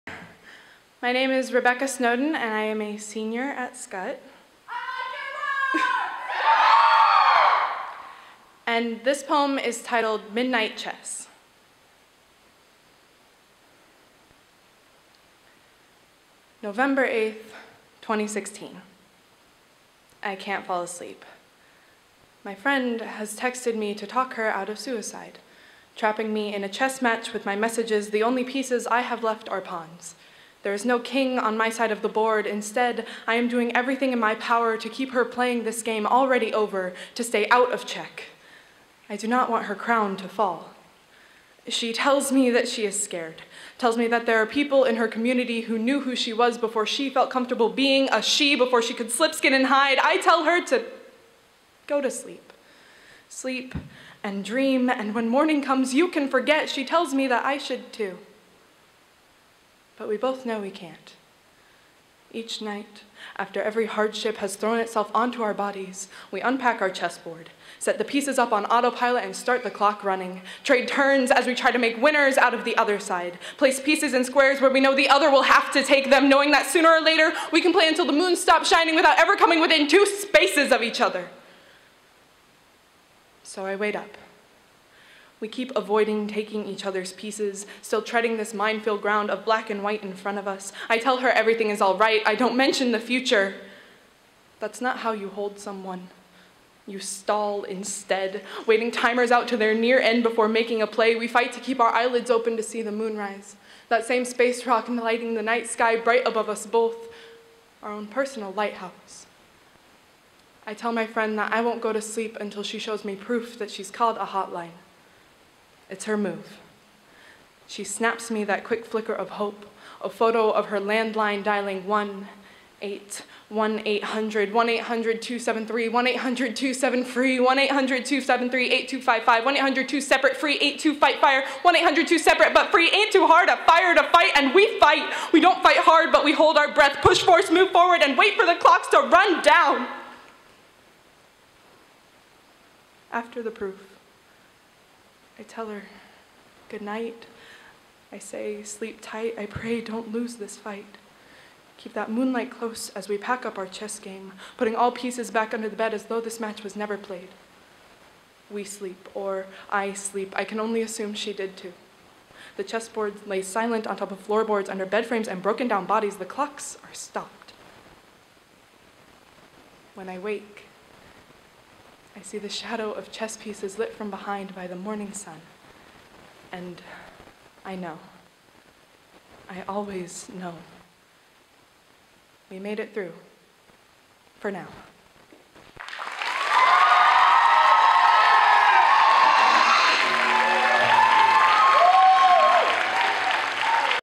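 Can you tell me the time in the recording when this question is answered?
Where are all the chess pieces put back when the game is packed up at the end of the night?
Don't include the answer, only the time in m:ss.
2:35.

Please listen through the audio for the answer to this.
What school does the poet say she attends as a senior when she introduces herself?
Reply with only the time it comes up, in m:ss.
0:03.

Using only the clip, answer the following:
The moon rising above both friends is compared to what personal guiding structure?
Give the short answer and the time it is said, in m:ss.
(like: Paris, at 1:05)
lighthouse, at 1:48.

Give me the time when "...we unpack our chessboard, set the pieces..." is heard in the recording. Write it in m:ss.
1:06.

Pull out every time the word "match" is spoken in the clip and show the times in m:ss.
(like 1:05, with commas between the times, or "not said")
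0:27, 2:36.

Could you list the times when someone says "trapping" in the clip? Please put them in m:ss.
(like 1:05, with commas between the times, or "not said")
0:25.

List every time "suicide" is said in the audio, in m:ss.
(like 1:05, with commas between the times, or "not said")
0:24.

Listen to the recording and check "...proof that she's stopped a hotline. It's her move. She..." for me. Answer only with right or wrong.
wrong.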